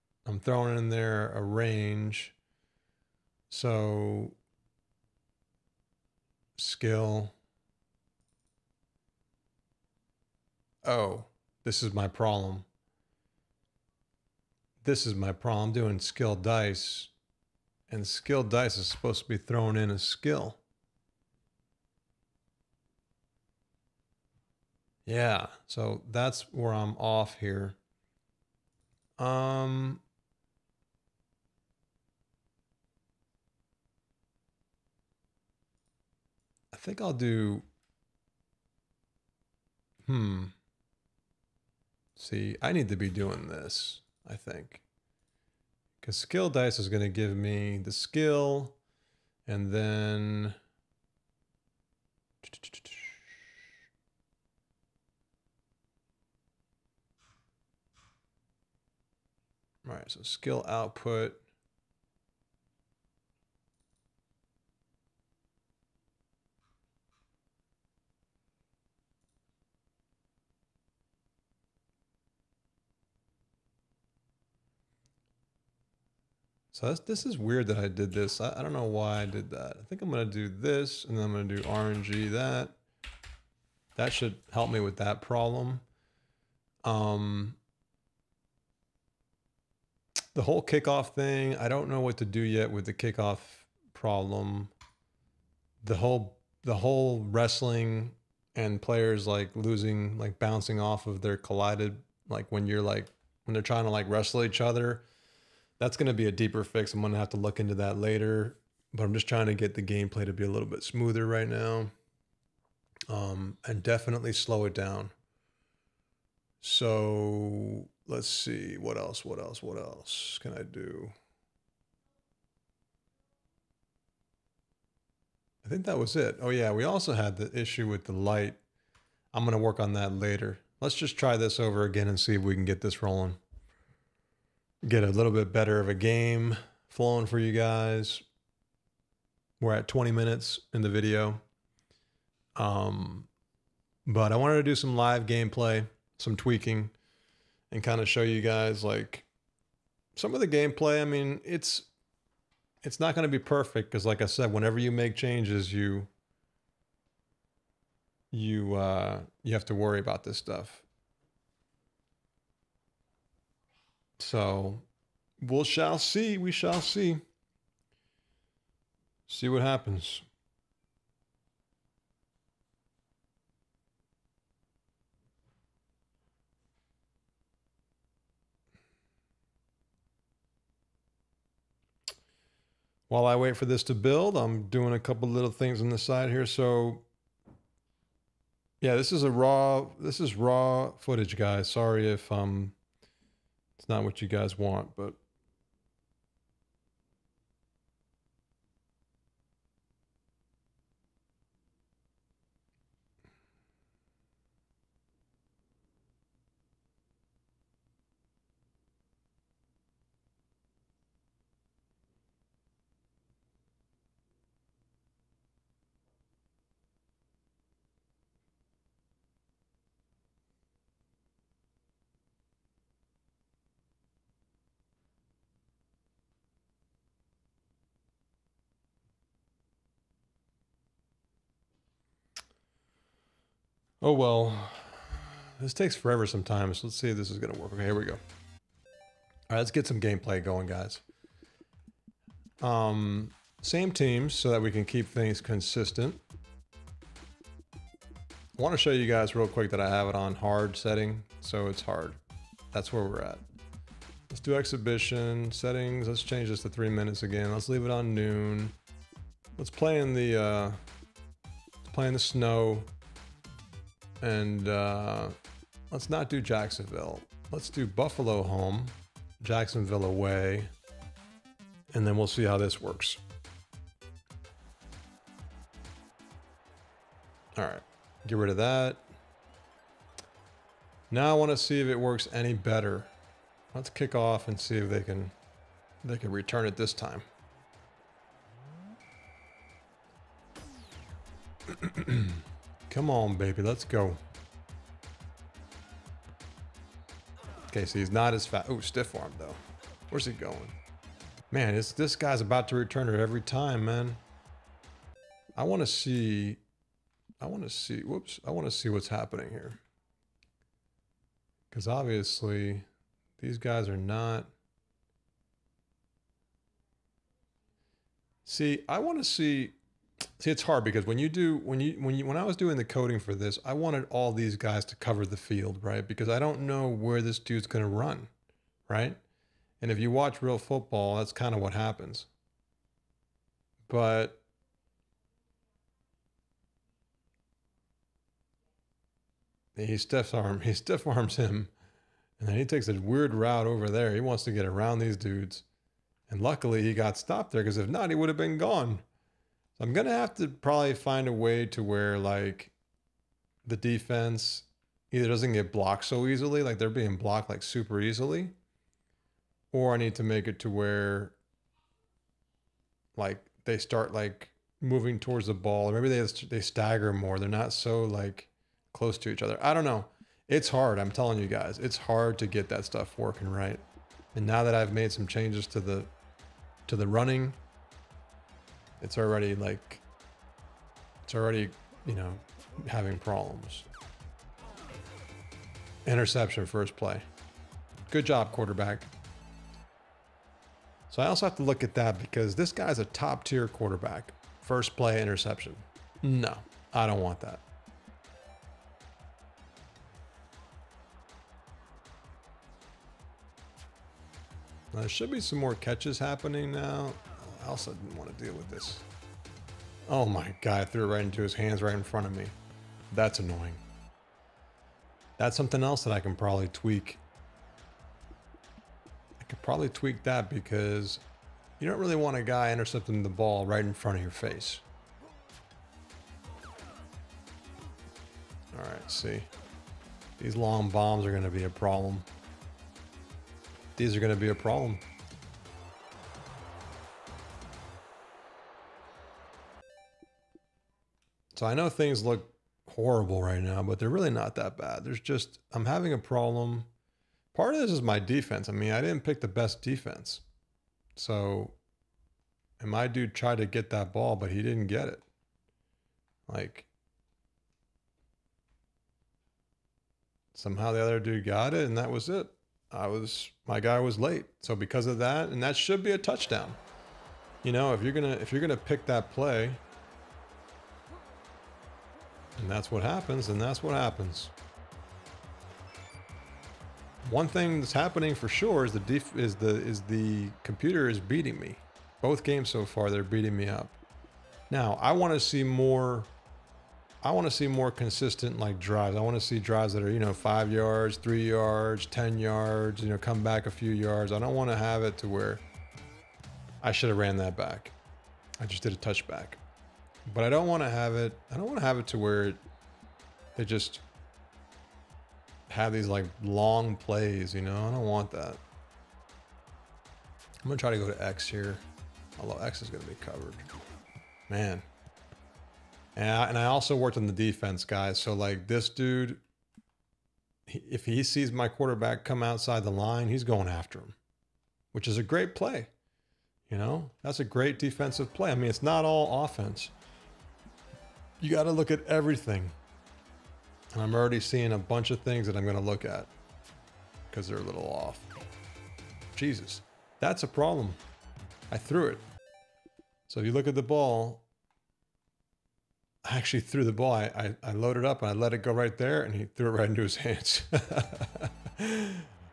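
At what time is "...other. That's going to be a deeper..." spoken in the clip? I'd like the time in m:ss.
1:44.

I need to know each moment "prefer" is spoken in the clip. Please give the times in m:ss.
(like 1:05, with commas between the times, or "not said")
not said.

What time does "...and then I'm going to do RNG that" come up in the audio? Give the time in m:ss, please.
1:21.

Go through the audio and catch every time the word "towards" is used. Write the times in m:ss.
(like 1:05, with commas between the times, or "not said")
6:05.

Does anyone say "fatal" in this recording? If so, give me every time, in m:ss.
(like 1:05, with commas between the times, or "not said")
not said.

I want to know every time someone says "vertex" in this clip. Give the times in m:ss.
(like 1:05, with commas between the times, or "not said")
not said.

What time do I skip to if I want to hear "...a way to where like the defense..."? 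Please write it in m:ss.
5:51.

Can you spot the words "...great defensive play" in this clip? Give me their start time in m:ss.
8:47.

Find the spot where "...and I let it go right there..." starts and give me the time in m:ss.
9:08.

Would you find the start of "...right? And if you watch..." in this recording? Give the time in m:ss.
5:28.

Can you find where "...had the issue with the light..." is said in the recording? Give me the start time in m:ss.
2:07.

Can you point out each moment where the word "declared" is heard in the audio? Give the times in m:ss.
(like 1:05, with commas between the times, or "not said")
not said.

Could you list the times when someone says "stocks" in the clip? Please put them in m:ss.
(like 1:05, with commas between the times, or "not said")
not said.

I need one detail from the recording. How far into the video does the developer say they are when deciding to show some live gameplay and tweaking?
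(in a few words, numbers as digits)
20 minutes.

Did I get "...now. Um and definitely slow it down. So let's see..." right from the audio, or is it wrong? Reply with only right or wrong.
right.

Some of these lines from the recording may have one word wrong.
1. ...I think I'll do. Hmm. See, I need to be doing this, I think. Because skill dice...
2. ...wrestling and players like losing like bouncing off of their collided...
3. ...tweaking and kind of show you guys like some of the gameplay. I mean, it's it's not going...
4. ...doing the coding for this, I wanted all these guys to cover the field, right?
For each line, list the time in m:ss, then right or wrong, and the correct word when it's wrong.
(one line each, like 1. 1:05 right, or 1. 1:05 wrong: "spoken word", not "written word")
1. 0:36 right
2. 1:37 right
3. 2:26 right
4. 5:22 right.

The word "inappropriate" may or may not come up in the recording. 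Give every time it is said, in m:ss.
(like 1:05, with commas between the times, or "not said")
not said.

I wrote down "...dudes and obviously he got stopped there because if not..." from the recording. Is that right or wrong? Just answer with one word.
wrong.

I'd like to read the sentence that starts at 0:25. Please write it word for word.
Yeah, so that's where I'm off here.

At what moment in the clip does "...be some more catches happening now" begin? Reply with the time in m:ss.
6:45.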